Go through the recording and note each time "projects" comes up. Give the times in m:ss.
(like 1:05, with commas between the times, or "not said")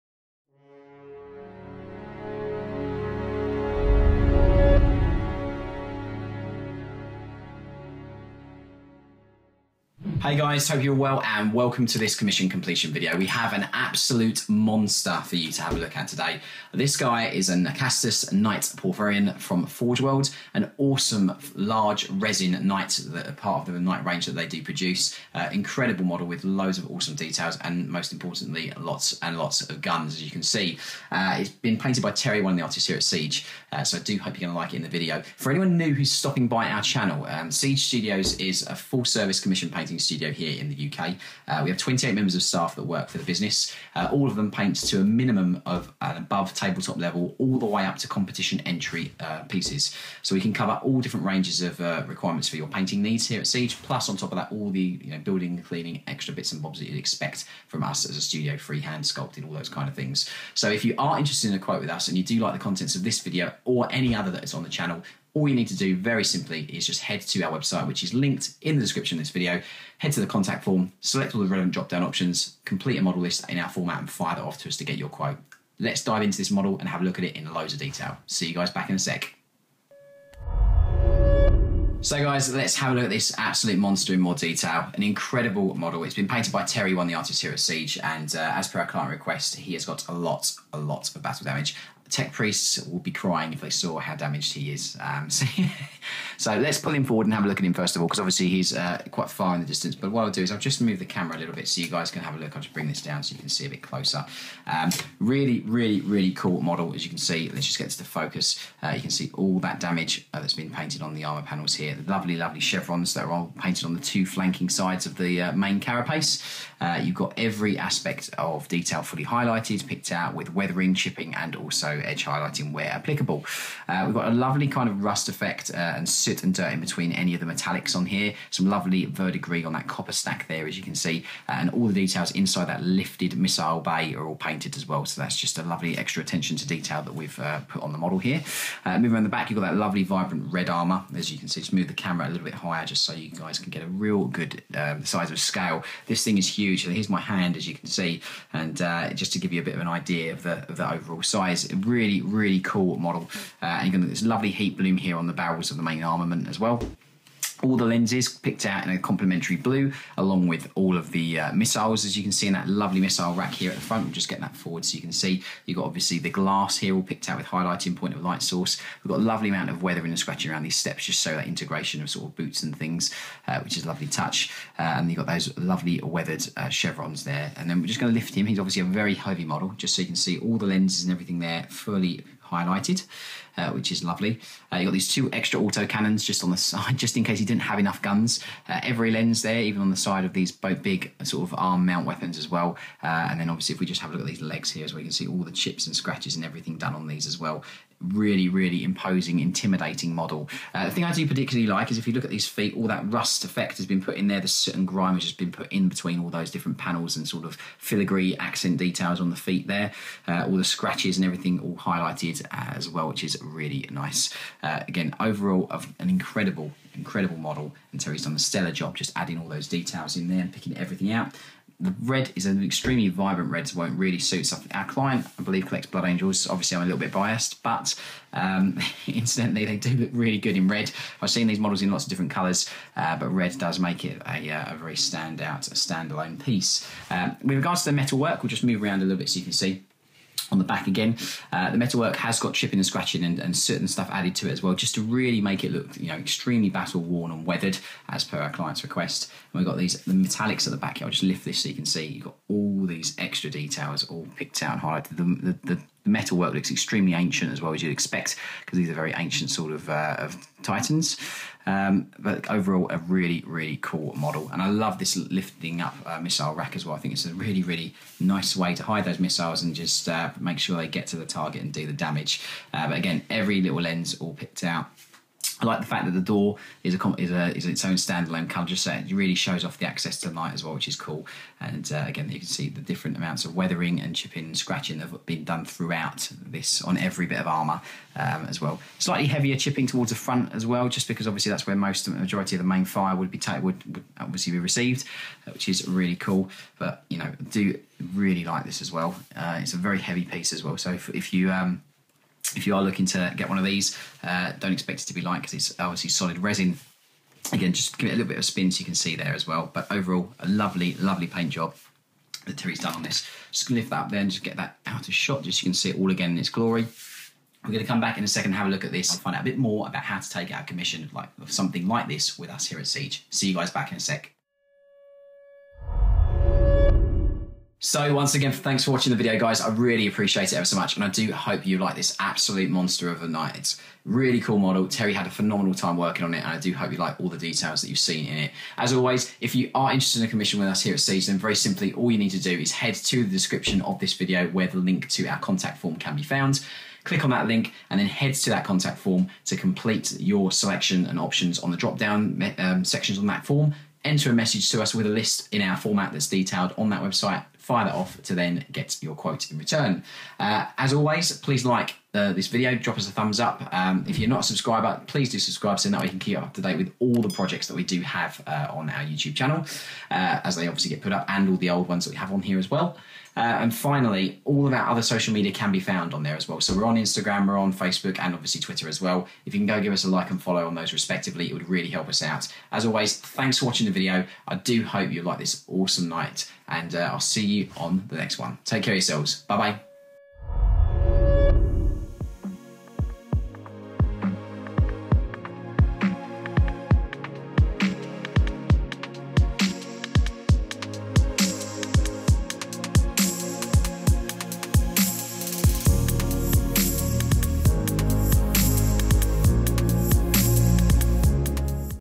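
6:07.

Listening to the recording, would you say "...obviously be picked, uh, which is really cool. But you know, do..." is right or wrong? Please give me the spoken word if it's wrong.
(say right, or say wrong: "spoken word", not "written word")
wrong: "received", not "picked".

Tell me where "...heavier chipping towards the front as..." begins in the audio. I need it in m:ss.
4:49.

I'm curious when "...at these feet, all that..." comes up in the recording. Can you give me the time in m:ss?
3:22.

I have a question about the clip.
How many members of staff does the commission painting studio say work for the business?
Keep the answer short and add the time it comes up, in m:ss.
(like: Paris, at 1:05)
28, at 0:41.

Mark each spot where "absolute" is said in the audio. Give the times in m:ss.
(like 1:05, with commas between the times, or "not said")
0:13, 1:23, 5:32.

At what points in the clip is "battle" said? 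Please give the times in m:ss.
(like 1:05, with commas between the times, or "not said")
1:31, 4:06.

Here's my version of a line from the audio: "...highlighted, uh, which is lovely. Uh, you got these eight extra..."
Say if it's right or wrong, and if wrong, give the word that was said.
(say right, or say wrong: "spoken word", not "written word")
wrong: "two", not "eight".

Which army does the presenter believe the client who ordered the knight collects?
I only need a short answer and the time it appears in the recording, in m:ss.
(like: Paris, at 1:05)
Blood Angels, at 3:45.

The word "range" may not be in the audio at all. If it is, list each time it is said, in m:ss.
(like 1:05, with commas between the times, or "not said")
0:24, 0:51.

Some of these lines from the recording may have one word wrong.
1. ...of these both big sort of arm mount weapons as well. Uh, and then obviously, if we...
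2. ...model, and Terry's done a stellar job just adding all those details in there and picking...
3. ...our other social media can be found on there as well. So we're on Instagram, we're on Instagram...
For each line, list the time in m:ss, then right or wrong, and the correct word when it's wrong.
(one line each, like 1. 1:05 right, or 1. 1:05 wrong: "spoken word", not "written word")
1. 3:10 right
2. 3:37 right
3. 6:14 wrong: "Facebook", not "Instagram".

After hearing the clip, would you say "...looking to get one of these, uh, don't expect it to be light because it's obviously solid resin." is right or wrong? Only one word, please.
right.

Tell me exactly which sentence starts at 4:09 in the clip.
And we've got these the metallics at the back.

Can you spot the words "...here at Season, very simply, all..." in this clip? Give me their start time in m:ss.
5:40.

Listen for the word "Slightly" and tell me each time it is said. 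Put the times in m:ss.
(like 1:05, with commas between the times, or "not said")
4:48.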